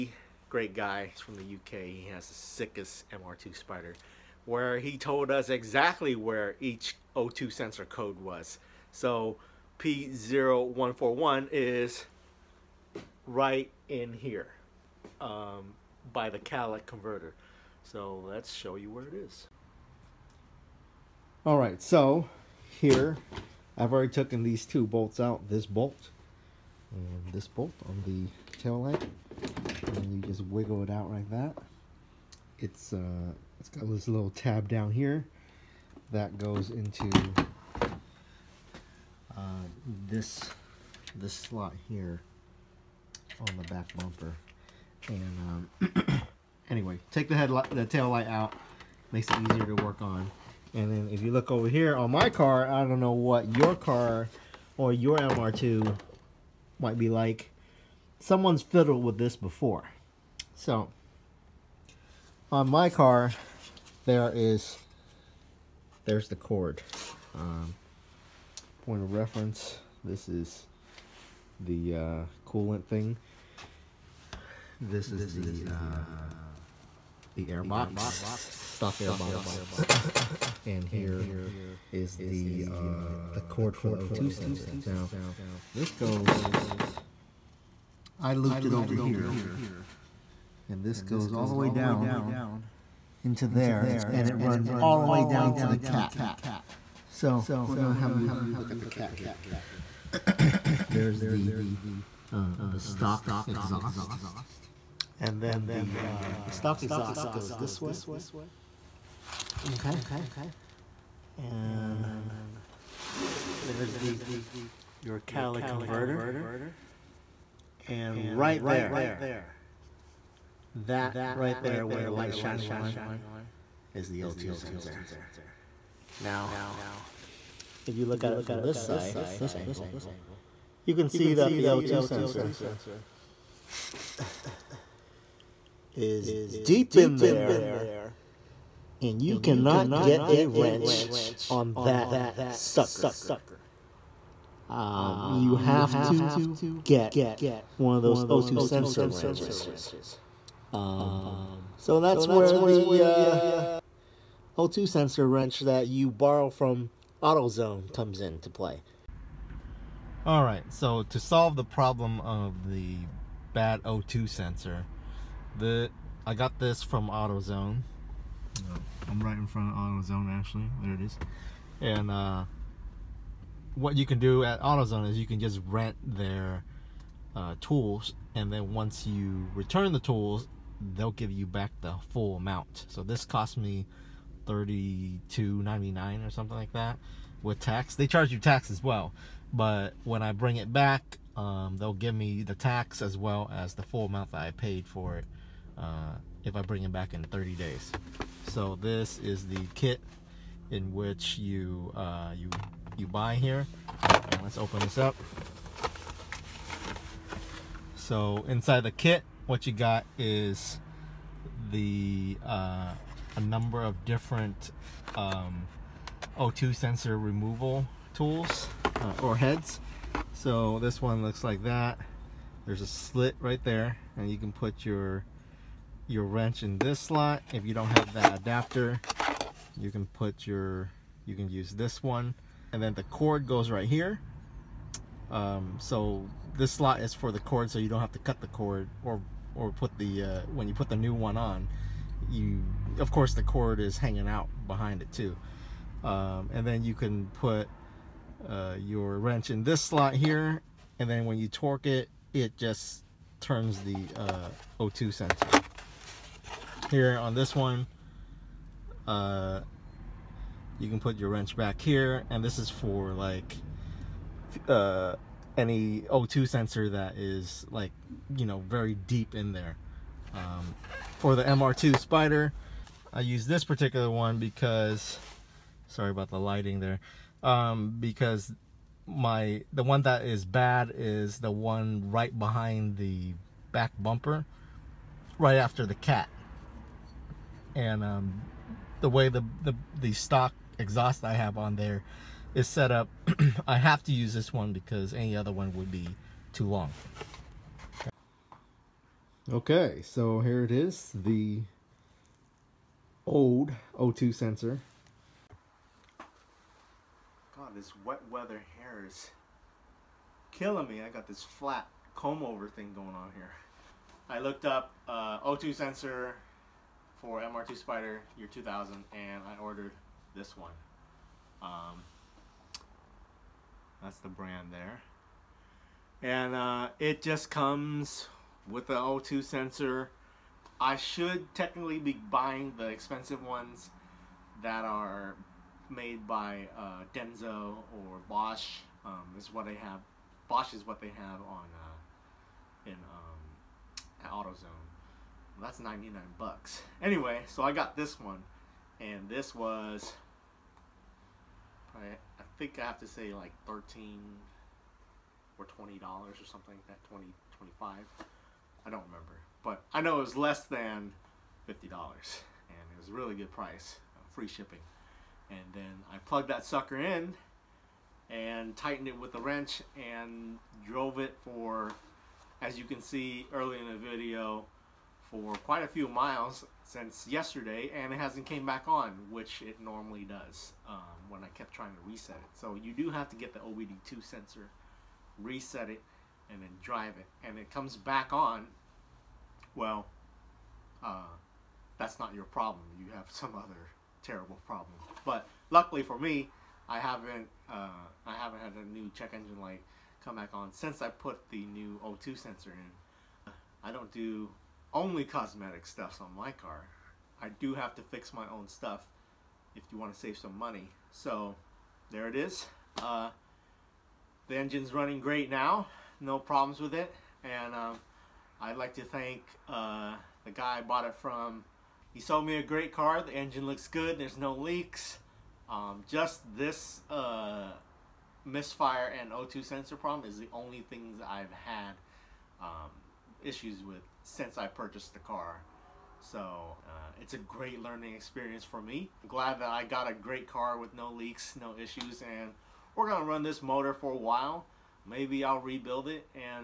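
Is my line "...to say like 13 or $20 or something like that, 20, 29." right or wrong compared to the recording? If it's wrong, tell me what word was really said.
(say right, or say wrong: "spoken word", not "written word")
wrong: "25", not "29".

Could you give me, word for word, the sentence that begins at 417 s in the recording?
And um, I'd like to thank uh, the guy I bought it from.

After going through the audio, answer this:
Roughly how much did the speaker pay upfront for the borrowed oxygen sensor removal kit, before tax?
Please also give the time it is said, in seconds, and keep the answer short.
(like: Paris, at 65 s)
$32.99, at 184 s.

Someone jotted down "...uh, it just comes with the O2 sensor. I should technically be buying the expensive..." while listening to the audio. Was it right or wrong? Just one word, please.
right.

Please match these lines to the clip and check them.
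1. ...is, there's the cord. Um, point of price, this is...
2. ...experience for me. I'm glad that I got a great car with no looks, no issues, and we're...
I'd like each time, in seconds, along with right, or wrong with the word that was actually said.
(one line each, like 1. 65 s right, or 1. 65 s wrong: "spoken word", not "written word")
1. 64 s wrong: "reference", not "price"
2. 438 s wrong: "leaks", not "looks".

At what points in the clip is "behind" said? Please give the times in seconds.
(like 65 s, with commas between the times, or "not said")
244 s, 282 s.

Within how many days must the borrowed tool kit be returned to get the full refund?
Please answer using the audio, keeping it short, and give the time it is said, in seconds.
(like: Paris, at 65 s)
30, at 197 s.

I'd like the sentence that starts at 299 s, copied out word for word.
Okay, so here it is, the old O2 sensor.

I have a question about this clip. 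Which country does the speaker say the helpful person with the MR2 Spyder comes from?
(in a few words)
UK.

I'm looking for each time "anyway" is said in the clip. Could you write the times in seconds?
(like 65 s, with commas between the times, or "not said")
46 s, 347 s.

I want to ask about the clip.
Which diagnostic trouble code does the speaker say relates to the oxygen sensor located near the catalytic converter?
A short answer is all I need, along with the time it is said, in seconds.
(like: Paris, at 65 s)
P0141, at 9 s.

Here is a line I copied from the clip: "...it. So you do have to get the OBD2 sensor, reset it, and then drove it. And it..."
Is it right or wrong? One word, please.
wrong.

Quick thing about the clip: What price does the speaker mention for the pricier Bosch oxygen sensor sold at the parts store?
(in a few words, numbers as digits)
$99.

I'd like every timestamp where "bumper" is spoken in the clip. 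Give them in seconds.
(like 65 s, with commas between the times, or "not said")
43 s, 283 s.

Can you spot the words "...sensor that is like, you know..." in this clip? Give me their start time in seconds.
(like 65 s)
266 s.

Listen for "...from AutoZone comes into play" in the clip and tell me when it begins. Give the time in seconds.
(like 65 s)
156 s.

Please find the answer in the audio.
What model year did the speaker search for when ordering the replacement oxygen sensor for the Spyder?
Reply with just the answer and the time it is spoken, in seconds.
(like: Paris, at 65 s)
2000, at 318 s.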